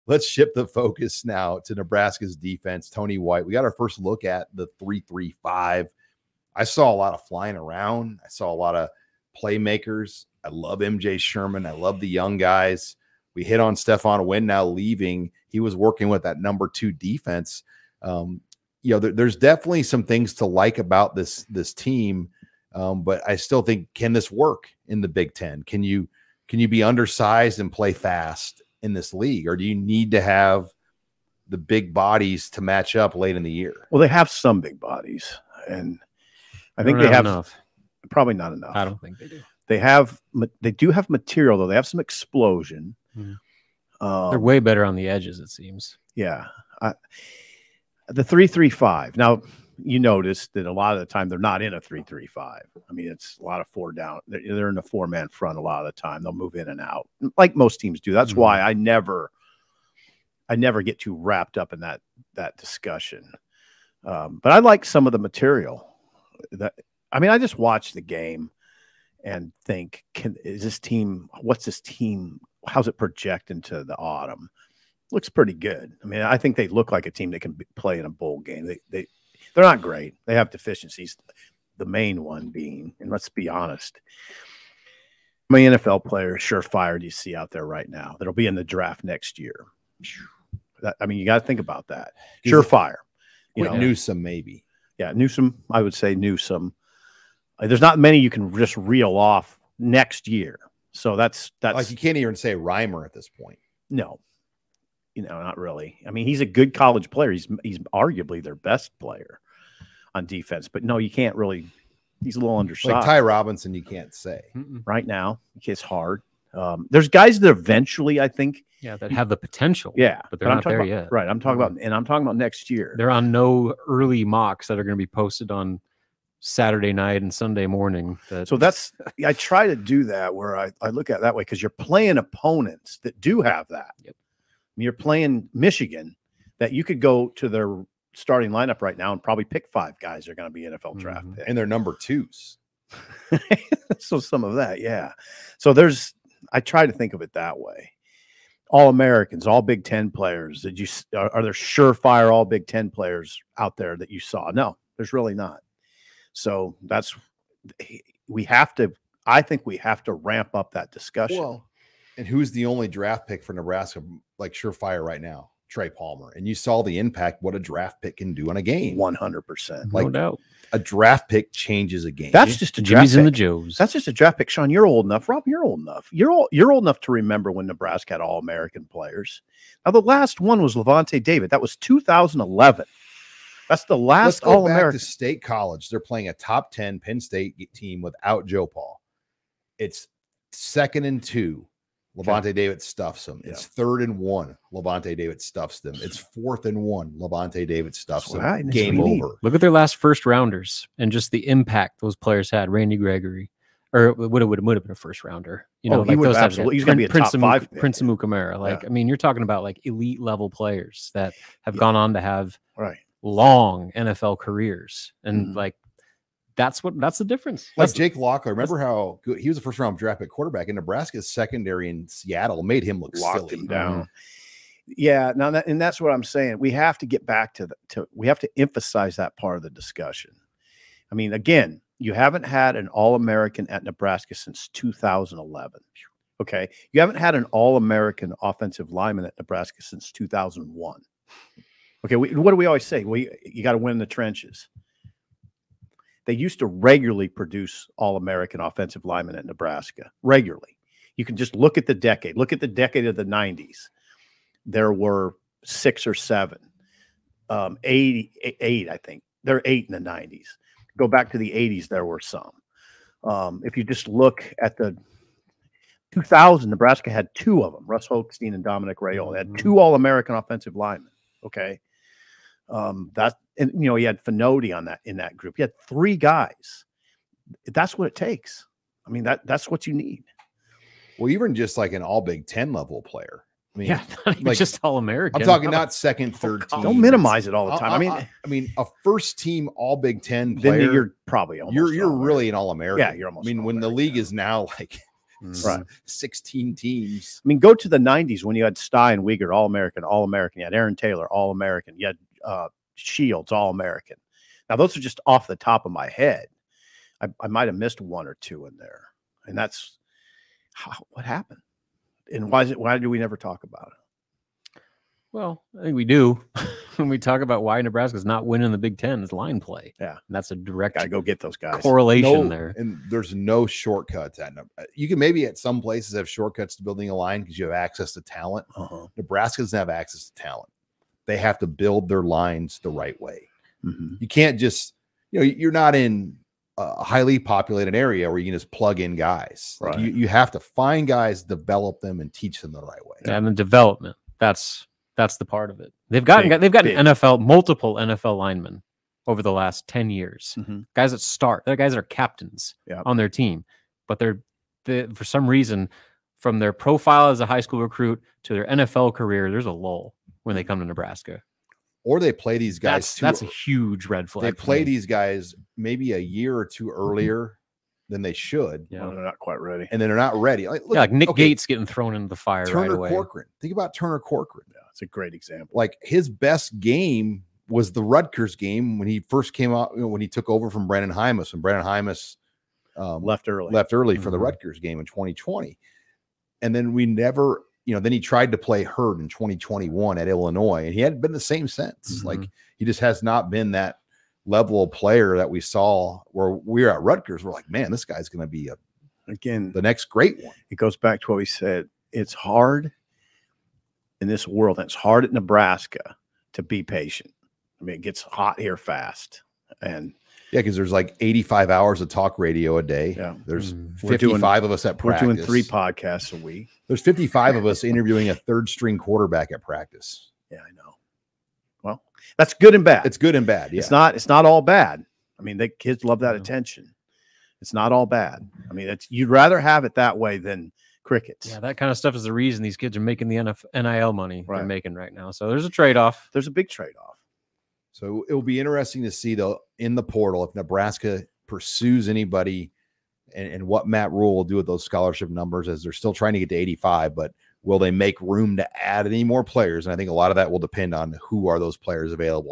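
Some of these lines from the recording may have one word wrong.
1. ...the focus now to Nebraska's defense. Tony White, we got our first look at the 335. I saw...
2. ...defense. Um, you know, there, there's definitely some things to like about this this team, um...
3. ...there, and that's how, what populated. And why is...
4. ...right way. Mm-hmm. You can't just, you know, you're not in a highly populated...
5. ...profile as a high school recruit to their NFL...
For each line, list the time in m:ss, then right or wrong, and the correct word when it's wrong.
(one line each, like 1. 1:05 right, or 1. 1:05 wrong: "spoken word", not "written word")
1. 0:00 right
2. 0:16 right
3. 5:08 wrong: "happened", not "populated"
4. 5:32 right
5. 5:56 right.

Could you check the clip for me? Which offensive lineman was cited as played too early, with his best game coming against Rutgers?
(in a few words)
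Turner Corcoran.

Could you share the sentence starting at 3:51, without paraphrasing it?
I mean, again, you haven't had an All-American at Nebraska since 2011.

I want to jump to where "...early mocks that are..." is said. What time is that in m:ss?
2:03.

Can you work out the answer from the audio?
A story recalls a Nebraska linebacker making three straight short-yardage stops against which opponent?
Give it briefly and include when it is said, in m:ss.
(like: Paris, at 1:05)
Penn State, at 3:06.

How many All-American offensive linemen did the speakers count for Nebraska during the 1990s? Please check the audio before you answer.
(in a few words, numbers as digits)
8.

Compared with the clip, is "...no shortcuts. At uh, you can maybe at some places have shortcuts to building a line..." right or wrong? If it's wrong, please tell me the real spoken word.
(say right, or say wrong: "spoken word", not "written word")
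right.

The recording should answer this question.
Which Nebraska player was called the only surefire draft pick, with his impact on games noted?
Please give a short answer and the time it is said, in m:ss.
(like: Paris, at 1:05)
Trey Palmer, at 2:45.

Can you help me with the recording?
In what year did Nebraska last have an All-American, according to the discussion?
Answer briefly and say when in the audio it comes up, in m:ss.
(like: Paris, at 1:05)
2011, at 3:01.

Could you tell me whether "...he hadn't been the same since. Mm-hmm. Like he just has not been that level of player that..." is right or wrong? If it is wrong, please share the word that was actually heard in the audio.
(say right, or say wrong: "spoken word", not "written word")
right.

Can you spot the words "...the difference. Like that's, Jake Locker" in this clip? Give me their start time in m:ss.
3:37.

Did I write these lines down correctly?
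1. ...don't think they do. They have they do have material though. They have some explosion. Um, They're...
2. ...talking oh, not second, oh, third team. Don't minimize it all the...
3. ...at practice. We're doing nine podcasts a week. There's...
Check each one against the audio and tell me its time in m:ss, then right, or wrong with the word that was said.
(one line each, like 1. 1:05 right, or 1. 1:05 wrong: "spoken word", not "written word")
1. 0:38 right
2. 4:45 right
3. 6:54 wrong: "three", not "nine".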